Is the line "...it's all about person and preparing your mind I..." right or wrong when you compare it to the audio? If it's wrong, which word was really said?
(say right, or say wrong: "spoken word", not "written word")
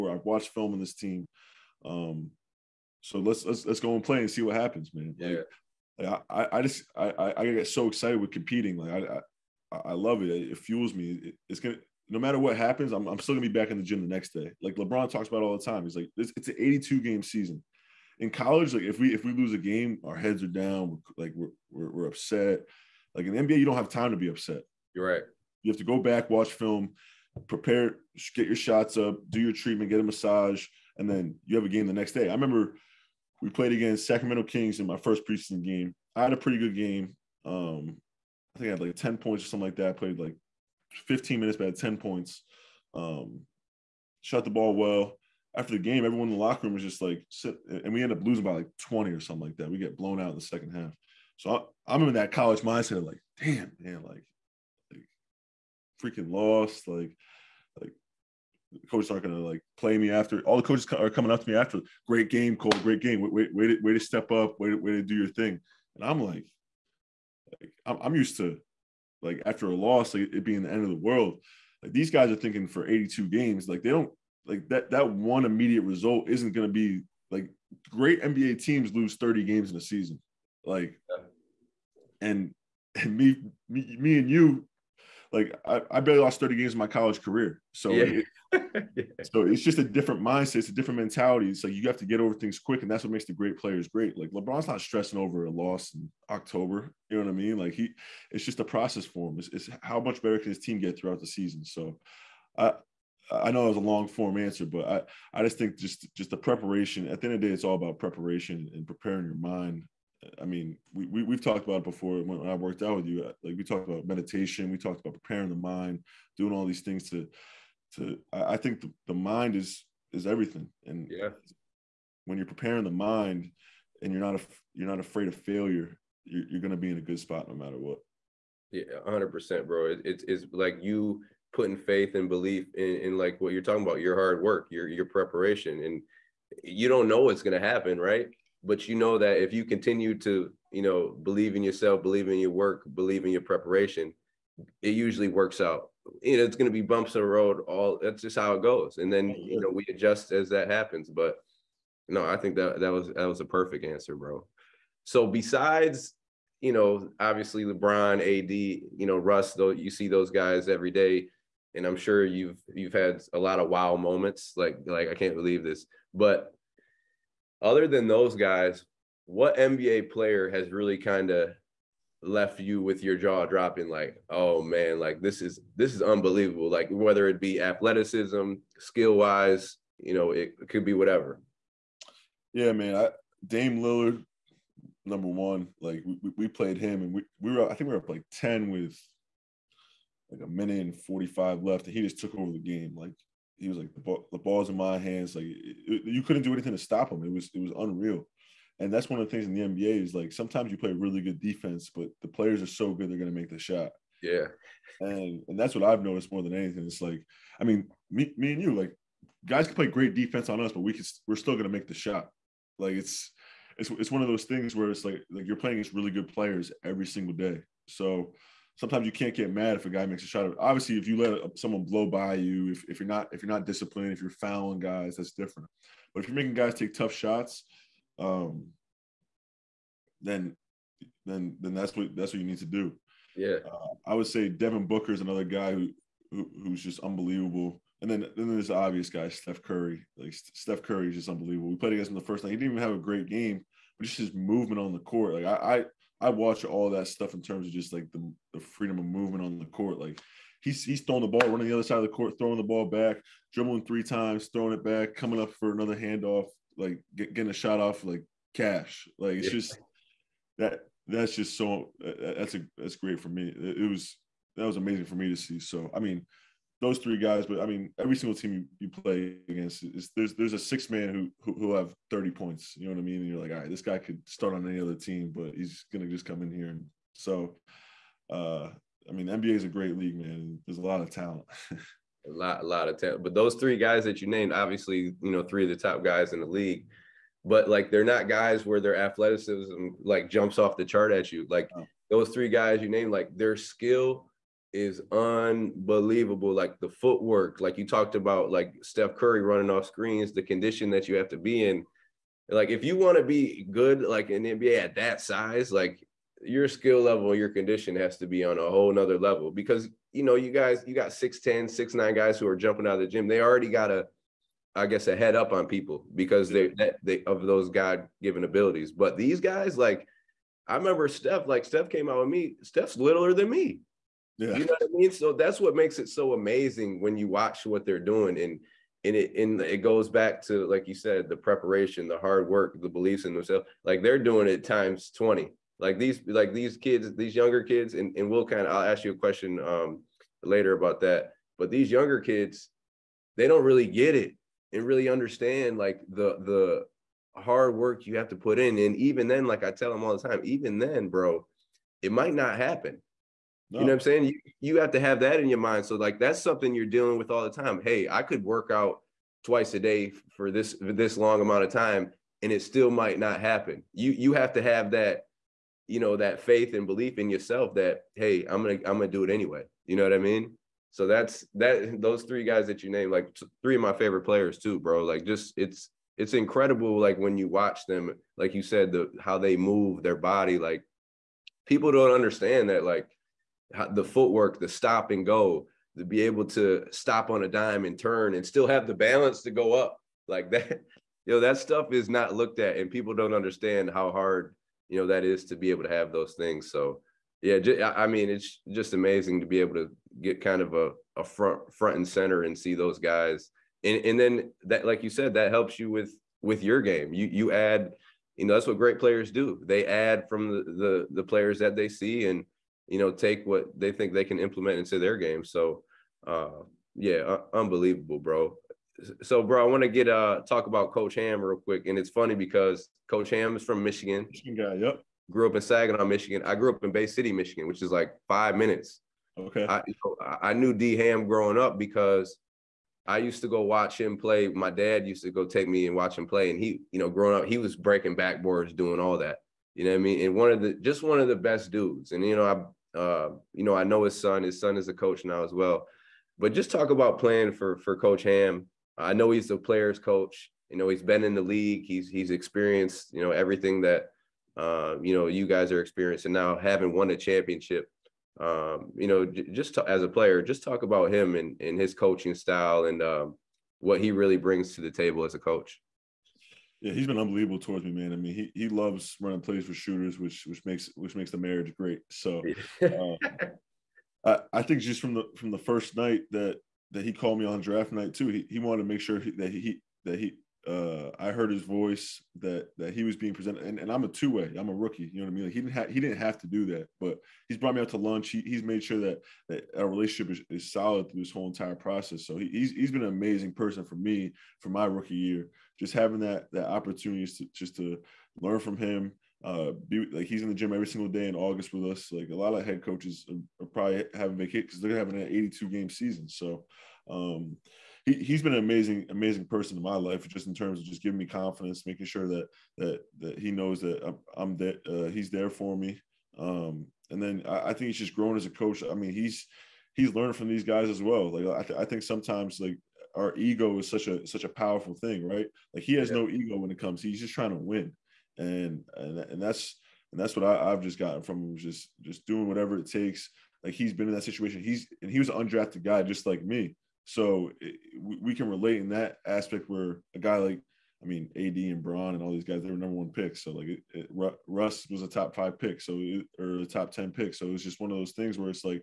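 wrong: "preparation", not "person".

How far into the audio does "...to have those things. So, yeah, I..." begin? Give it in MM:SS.
06:35.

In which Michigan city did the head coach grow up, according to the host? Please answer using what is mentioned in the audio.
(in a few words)
Saginaw.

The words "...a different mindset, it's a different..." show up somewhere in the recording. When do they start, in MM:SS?
01:29.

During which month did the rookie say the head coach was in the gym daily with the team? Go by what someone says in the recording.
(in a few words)
August.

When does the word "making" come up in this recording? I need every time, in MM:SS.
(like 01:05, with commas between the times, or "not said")
03:46, 08:31.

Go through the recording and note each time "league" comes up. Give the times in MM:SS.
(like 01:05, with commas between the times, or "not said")
04:39, 04:46, 07:31.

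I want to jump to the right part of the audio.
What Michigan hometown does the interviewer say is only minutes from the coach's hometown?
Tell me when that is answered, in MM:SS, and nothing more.
07:06.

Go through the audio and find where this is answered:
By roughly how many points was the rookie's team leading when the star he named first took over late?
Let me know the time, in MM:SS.
03:07.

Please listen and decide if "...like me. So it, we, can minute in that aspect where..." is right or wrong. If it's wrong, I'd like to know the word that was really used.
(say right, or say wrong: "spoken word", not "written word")
wrong: "relate", not "minute".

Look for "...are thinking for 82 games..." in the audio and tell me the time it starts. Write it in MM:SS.
01:12.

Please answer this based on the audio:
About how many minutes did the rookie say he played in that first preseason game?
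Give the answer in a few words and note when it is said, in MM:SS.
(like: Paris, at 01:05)
15, at 00:41.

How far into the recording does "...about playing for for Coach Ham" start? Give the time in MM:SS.
07:26.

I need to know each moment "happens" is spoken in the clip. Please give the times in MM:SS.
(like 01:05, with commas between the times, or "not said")
00:04, 00:12, 02:17, 02:30, 05:52, 06:03.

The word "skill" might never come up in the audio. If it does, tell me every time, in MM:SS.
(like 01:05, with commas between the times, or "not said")
02:58, 04:53, 05:06.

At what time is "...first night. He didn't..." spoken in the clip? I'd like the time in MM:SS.
04:02.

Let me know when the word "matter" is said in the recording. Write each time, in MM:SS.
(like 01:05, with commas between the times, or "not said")
00:12, 02:07.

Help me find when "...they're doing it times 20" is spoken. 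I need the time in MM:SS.
05:34.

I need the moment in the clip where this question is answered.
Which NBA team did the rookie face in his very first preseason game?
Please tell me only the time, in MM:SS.
00:34.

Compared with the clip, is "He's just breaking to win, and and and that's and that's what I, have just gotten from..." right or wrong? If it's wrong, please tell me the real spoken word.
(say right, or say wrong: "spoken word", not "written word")
wrong: "trying", not "breaking".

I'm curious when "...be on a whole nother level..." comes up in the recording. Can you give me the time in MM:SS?
05:08.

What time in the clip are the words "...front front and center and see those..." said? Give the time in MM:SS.
06:41.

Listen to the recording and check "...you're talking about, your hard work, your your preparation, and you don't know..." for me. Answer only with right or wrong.
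right.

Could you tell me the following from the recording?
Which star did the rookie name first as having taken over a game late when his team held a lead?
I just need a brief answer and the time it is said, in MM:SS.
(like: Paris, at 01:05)
Dame Lillard, at 03:03.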